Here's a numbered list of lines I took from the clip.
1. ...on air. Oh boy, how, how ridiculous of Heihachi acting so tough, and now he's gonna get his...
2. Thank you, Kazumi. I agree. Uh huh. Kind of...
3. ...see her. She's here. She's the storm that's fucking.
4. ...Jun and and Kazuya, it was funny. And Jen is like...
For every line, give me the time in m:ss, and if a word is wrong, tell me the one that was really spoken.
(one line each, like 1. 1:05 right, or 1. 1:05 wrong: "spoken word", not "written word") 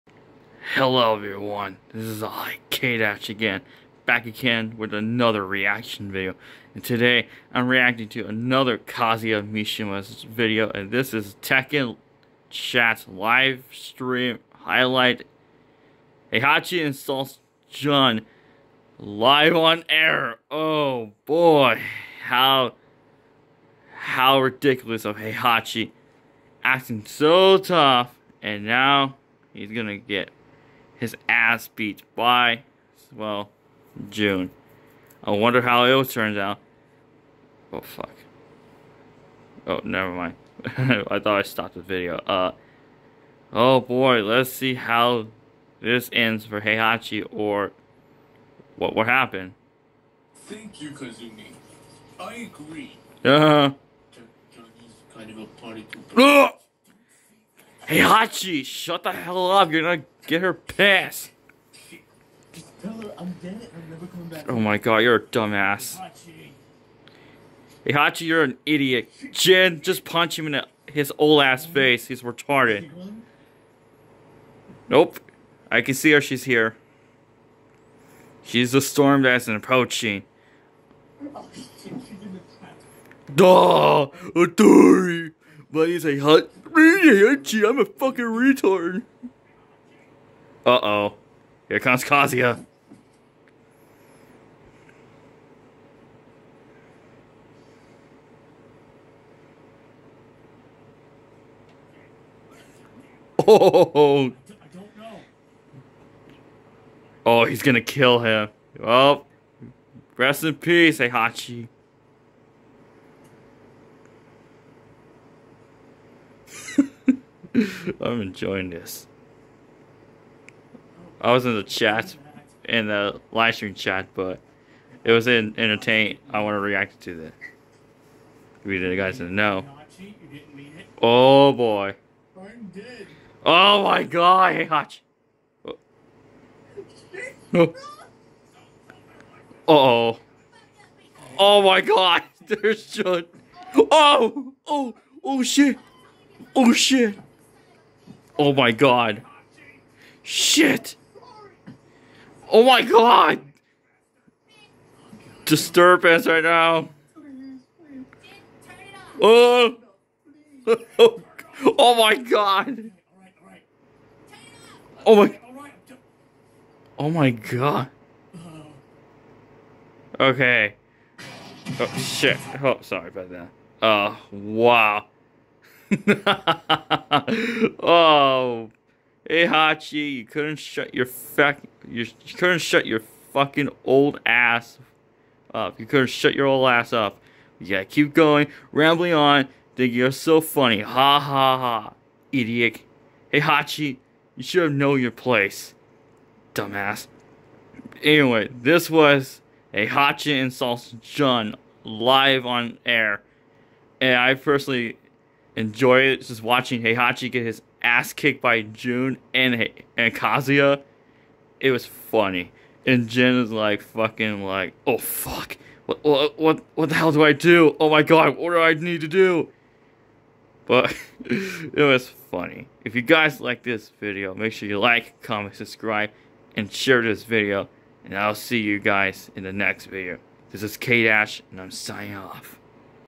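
1. 0:19 right
2. 0:50 right
3. 1:15 wrong: "approaching", not "fucking"
4. 3:28 right.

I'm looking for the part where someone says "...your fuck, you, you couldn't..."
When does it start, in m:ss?
3:00.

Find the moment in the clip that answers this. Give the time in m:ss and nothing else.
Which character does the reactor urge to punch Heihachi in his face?
1:09.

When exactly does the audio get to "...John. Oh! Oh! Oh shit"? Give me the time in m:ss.
2:22.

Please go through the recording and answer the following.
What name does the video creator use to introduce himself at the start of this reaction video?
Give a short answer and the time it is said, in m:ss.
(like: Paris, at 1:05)
K-Dash, at 0:02.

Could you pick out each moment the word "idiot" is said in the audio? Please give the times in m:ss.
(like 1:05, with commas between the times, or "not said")
1:08, 3:12.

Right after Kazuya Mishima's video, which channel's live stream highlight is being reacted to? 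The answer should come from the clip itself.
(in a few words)
Tekken Chat.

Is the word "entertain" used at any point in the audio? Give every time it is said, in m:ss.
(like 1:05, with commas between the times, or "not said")
2:05.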